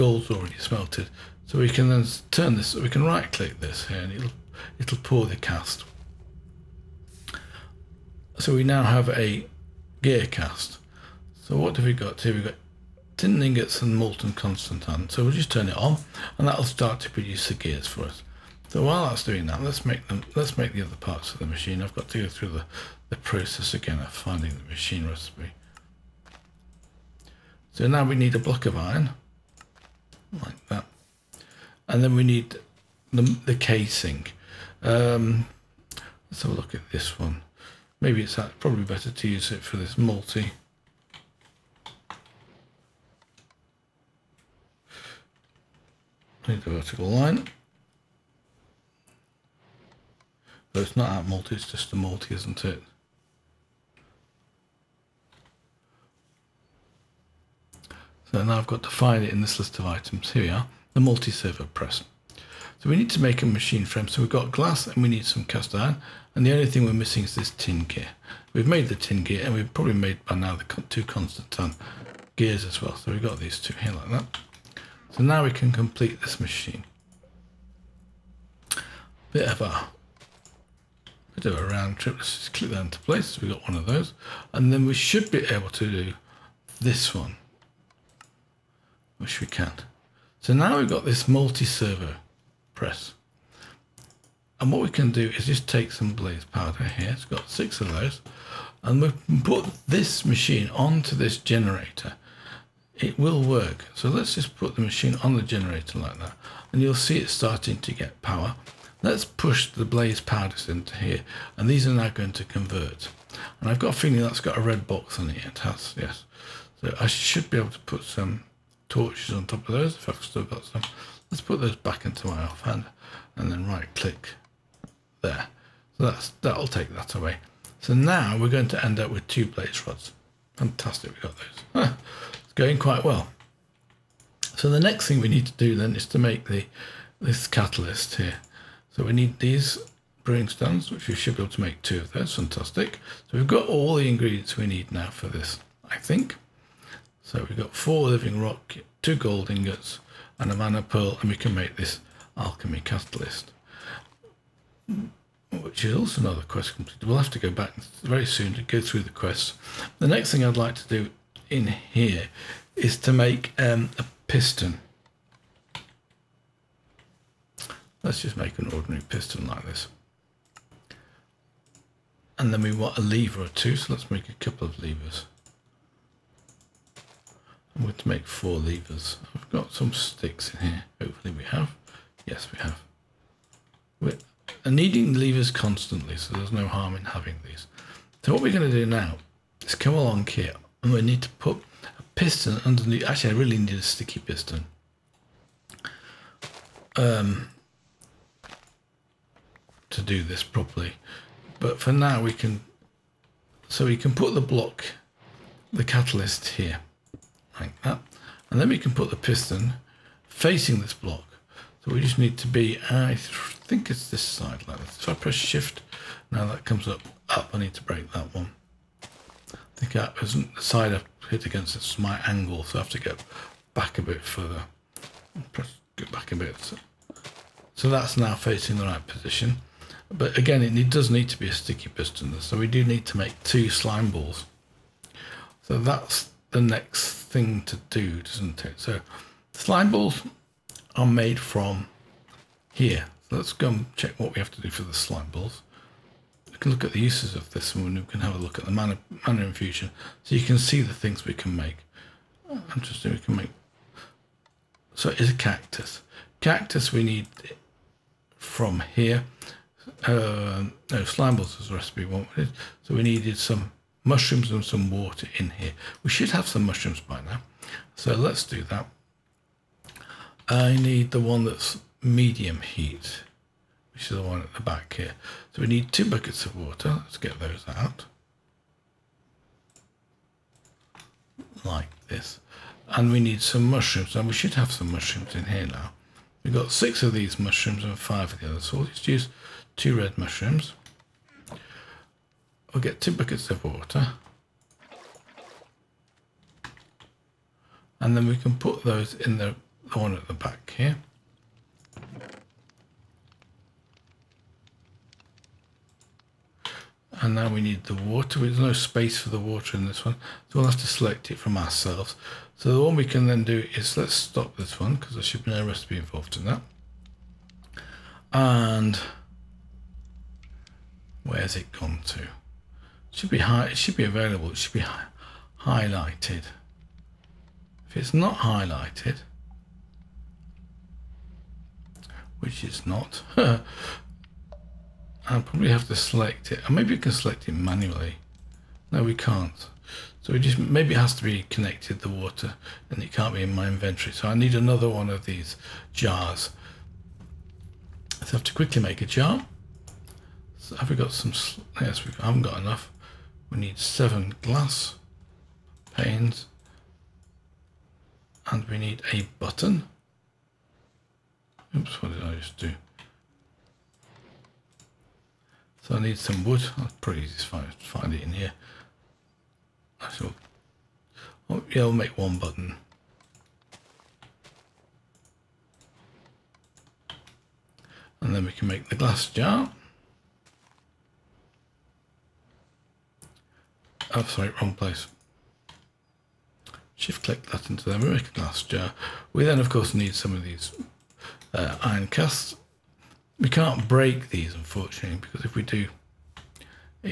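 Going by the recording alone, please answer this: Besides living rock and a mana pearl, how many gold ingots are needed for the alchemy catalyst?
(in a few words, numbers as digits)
2.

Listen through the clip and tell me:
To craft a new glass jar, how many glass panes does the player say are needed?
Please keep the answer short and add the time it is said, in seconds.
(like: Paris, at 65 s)
7, at 353 s.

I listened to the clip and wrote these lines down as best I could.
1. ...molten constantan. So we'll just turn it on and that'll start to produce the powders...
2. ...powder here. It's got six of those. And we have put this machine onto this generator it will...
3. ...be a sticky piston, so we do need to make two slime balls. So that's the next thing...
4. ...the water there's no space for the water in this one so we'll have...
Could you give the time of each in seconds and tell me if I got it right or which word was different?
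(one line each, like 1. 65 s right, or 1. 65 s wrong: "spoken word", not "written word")
1. 13 s wrong: "gears", not "powders"
2. 96 s right
3. 231 s right
4. 307 s right.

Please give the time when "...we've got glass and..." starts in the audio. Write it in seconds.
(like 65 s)
64 s.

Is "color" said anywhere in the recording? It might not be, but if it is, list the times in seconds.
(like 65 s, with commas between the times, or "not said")
not said.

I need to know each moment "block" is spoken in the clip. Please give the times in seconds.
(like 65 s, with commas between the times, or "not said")
28 s, 204 s, 210 s.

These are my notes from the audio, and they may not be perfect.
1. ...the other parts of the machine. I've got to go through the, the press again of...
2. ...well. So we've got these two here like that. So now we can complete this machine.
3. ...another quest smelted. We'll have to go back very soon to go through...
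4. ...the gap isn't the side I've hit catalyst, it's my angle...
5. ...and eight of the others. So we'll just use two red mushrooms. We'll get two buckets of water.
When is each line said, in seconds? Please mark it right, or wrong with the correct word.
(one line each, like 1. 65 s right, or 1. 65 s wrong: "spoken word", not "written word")
1. 20 s wrong: "process", not "press"
2. 72 s right
3. 156 s wrong: "completed", not "smelted"
4. 219 s wrong: "against", not "catalyst"
5. 287 s wrong: "five", not "eight".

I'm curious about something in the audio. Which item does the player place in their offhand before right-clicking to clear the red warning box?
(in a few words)
torches.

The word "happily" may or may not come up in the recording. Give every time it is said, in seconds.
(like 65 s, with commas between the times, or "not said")
not said.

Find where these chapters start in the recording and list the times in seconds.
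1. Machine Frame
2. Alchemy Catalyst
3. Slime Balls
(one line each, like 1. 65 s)
1. 76 s
2. 145 s
3. 241 s.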